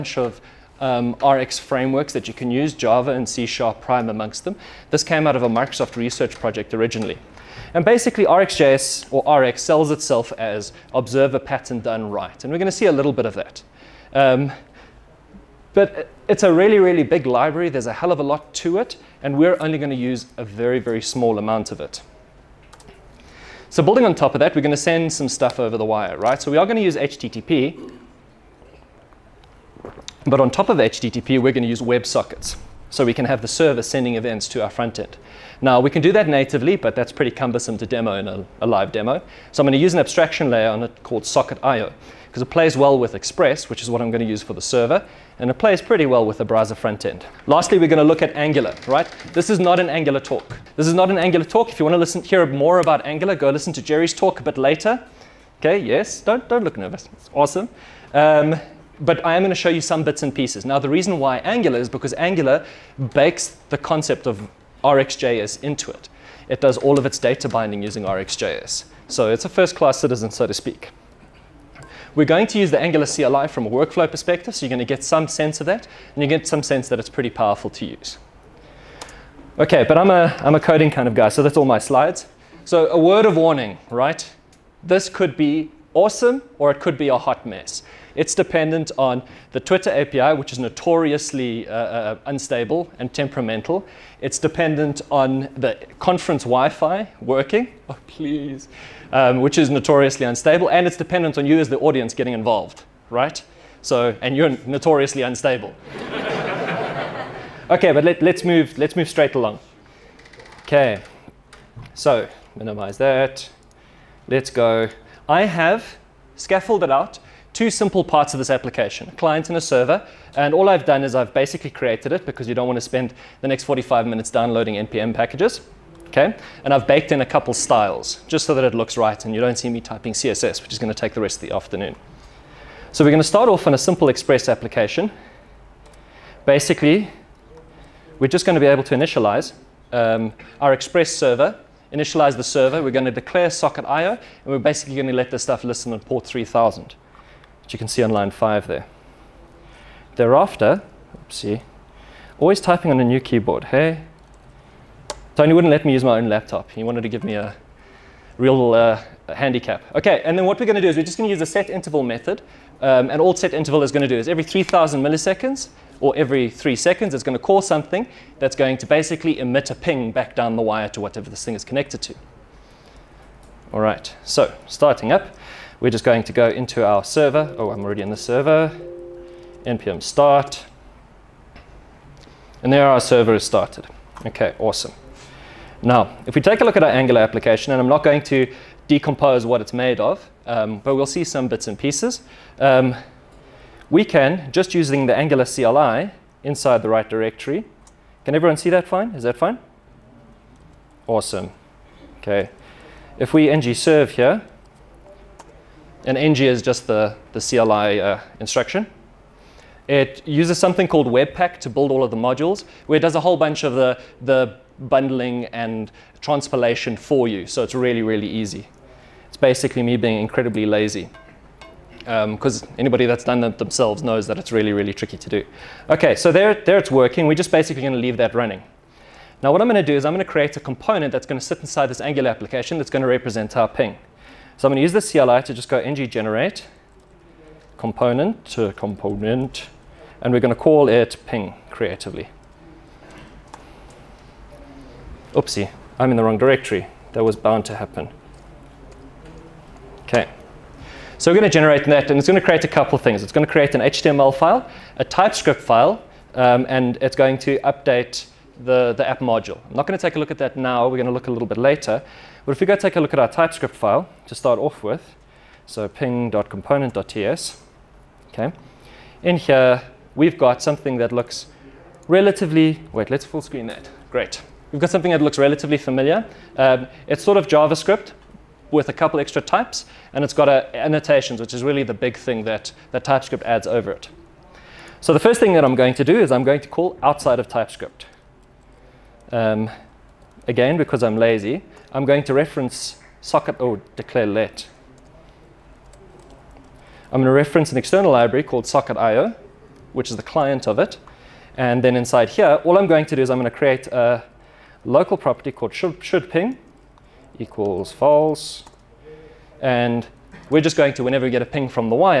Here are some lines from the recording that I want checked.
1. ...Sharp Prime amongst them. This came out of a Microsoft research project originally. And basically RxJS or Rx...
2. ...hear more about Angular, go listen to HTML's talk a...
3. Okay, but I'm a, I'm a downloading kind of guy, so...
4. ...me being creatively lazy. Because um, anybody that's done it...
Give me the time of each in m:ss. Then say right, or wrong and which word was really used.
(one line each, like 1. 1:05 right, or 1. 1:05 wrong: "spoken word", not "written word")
1. 0:03 right
2. 0:52 wrong: "Jerry", not "HTML"
3. 1:19 wrong: "coding", not "downloading"
4. 3:39 wrong: "incredibly", not "creatively".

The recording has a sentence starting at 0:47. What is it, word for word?
Lastly, we're going to look at Angular, right?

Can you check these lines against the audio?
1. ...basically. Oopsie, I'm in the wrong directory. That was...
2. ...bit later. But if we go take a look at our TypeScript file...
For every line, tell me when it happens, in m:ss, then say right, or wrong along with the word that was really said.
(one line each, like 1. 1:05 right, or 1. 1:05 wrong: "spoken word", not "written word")
1. 4:01 wrong: "creatively", not "basically"
2. 4:21 right.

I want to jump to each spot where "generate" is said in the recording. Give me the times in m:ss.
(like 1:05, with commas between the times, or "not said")
3:56, 4:11.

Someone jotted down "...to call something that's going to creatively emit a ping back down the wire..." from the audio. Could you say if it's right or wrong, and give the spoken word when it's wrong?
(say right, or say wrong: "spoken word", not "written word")
wrong: "basically", not "creatively".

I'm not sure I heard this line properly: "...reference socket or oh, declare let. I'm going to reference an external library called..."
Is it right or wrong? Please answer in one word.
right.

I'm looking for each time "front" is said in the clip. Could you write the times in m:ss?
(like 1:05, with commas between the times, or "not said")
0:34, 0:46.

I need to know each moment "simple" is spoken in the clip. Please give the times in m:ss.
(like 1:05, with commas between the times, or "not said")
1:57, 2:13.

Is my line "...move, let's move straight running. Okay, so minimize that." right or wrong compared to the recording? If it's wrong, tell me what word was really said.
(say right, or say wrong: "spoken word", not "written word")
wrong: "along", not "running".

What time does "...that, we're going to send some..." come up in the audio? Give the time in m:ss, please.
0:24.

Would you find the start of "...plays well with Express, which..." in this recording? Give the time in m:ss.
0:42.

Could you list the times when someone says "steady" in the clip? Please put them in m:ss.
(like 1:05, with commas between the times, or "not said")
not said.